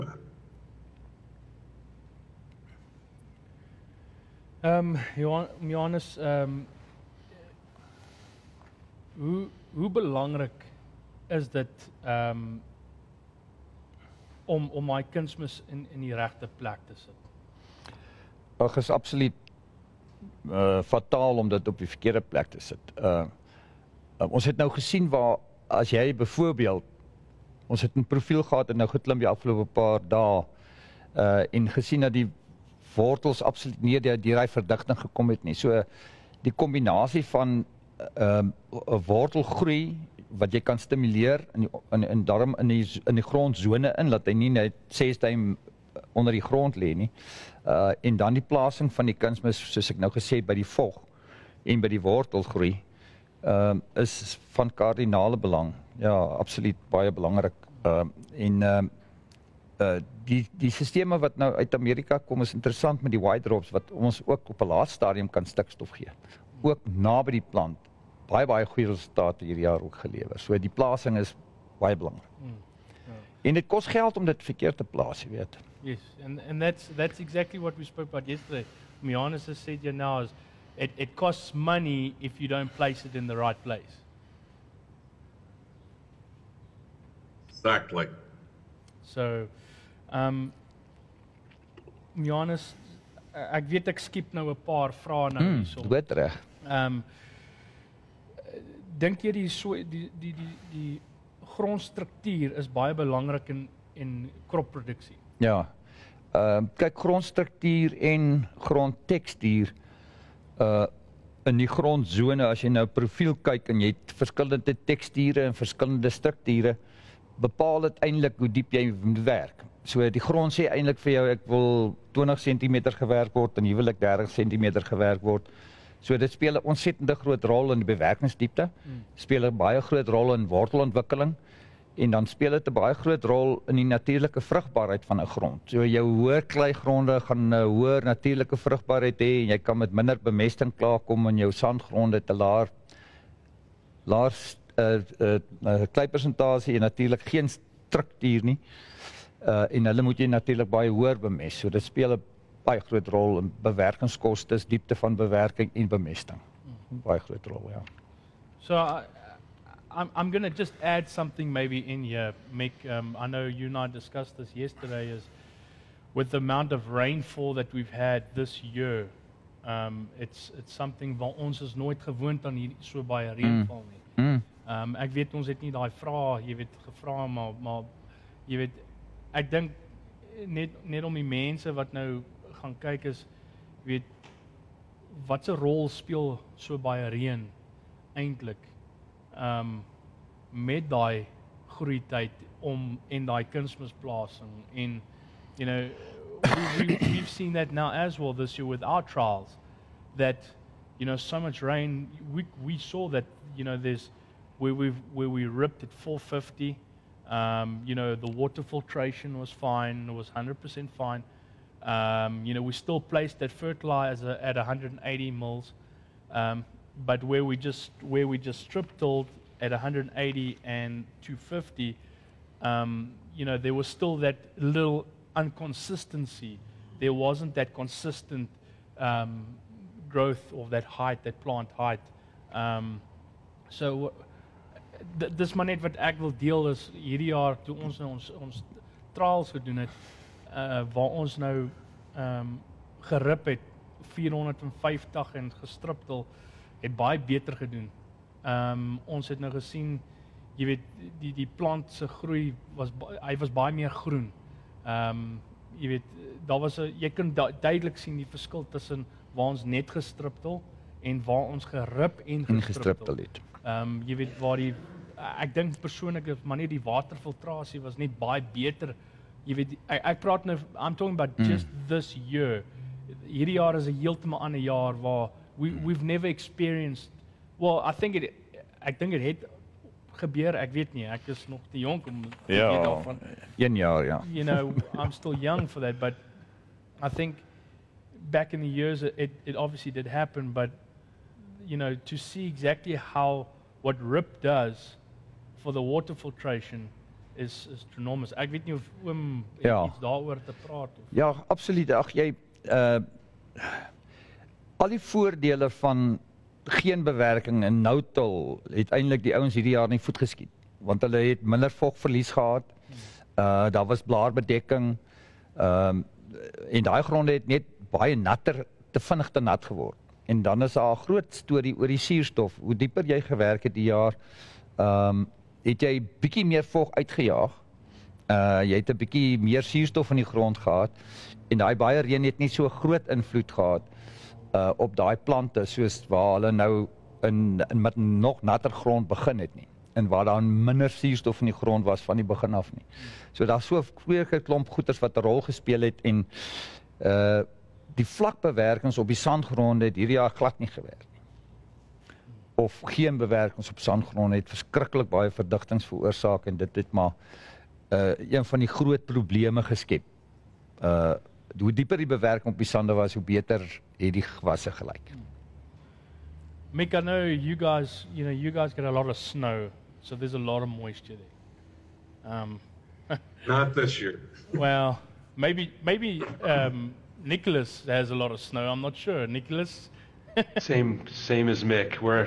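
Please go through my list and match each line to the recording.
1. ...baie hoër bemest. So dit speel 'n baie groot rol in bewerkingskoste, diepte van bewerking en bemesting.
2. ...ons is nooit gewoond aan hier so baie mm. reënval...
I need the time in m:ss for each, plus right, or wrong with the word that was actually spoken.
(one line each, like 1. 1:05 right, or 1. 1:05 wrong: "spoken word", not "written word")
1. 2:30 right
2. 2:51 right.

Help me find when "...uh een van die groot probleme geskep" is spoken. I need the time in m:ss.
5:57.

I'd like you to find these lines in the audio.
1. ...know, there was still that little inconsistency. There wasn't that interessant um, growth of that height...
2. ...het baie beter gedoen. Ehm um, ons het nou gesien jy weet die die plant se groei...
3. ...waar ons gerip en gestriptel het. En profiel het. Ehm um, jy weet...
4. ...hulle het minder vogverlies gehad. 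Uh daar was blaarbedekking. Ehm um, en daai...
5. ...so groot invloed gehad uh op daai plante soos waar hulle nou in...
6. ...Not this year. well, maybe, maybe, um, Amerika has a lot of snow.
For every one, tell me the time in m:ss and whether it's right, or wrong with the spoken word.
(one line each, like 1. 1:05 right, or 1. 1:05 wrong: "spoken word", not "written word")
1. 3:43 wrong: "consistent", not "interessant"
2. 4:06 right
3. 4:21 wrong: "gestriptel", not "profiel"
4. 5:11 right
5. 5:32 right
6. 6:13 wrong: "Nicholas", not "Amerika".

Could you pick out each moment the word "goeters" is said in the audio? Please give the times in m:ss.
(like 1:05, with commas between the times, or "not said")
5:44.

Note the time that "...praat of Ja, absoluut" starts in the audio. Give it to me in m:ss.
5:00.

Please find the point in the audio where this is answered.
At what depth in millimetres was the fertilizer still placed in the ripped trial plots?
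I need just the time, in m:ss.
3:34.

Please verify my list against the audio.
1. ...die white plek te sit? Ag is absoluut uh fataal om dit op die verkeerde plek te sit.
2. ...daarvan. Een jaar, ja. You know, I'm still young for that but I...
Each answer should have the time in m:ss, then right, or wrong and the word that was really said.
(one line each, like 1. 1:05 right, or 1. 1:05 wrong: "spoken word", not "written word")
1. 0:16 wrong: "regte", not "white"
2. 4:42 right.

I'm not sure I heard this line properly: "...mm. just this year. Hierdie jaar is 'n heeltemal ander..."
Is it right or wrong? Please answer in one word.
right.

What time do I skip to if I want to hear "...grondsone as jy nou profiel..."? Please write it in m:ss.
1:51.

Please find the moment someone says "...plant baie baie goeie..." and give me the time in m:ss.
1:07.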